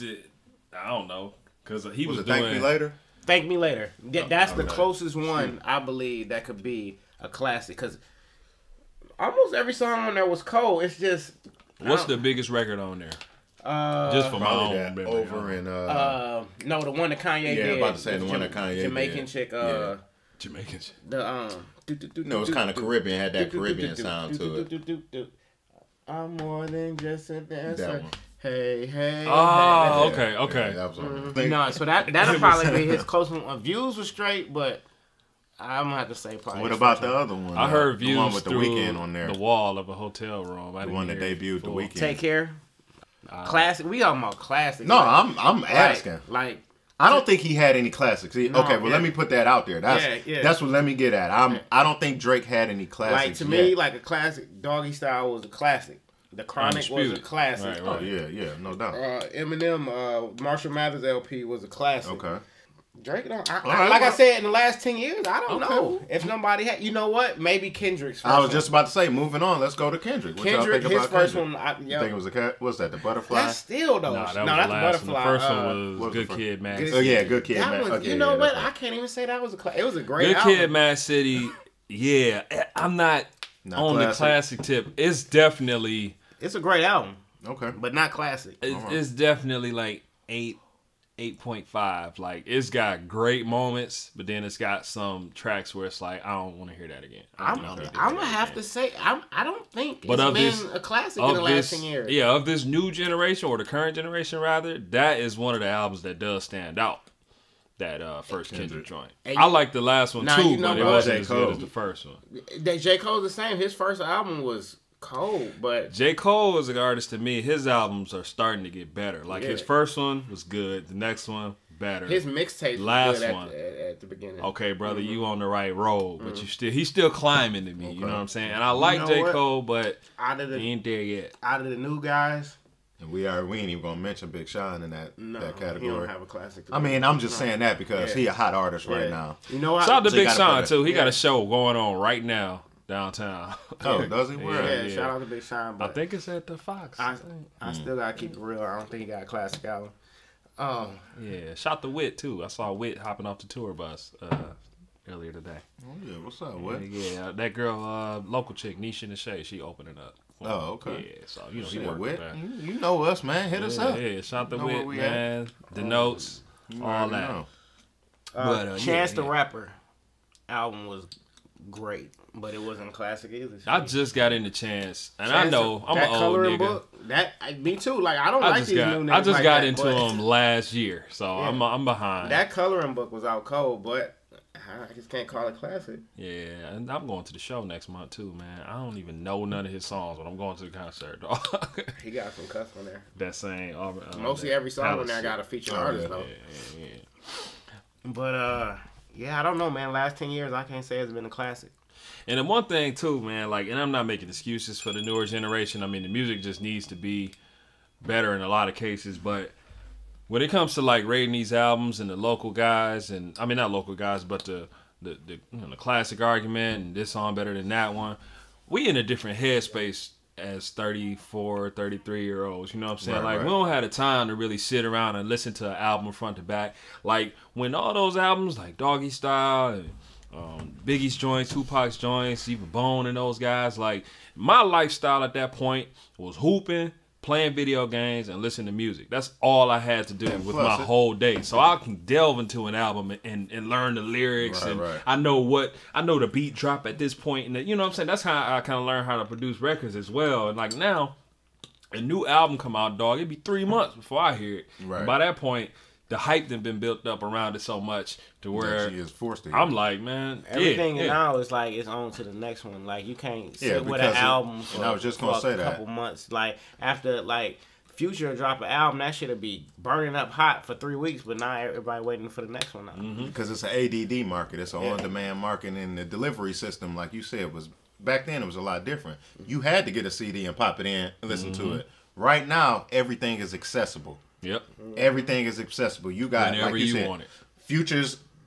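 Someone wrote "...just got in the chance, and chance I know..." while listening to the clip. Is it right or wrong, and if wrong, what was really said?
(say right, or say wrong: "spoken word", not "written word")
right.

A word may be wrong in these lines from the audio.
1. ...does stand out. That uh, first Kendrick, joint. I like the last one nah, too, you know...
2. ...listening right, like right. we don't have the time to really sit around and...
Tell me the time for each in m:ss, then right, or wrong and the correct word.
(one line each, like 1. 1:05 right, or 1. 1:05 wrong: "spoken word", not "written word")
1. 1:46 right
2. 3:42 wrong: "saying", not "listening".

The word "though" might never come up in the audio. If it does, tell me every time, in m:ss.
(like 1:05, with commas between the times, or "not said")
1:14, 3:16.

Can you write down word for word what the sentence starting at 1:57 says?
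His albums are starting to get better.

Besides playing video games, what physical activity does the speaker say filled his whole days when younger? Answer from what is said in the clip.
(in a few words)
hooping.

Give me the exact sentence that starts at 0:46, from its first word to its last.
Like, like I don't think he had any classics.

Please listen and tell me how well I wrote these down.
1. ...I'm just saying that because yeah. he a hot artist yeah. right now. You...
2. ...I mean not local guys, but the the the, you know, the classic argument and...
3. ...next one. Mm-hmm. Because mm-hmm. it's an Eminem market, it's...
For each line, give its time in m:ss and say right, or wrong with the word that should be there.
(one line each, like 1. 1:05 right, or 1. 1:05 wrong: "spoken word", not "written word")
1. 2:17 right
2. 3:33 right
3. 4:32 wrong: "ADD", not "Eminem".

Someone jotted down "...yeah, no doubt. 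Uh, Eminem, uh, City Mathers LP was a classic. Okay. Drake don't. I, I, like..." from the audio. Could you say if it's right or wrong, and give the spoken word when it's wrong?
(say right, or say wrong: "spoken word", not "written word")
wrong: "Marshall", not "City".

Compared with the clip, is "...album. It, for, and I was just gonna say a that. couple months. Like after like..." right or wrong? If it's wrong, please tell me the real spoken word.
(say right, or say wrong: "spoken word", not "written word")
right.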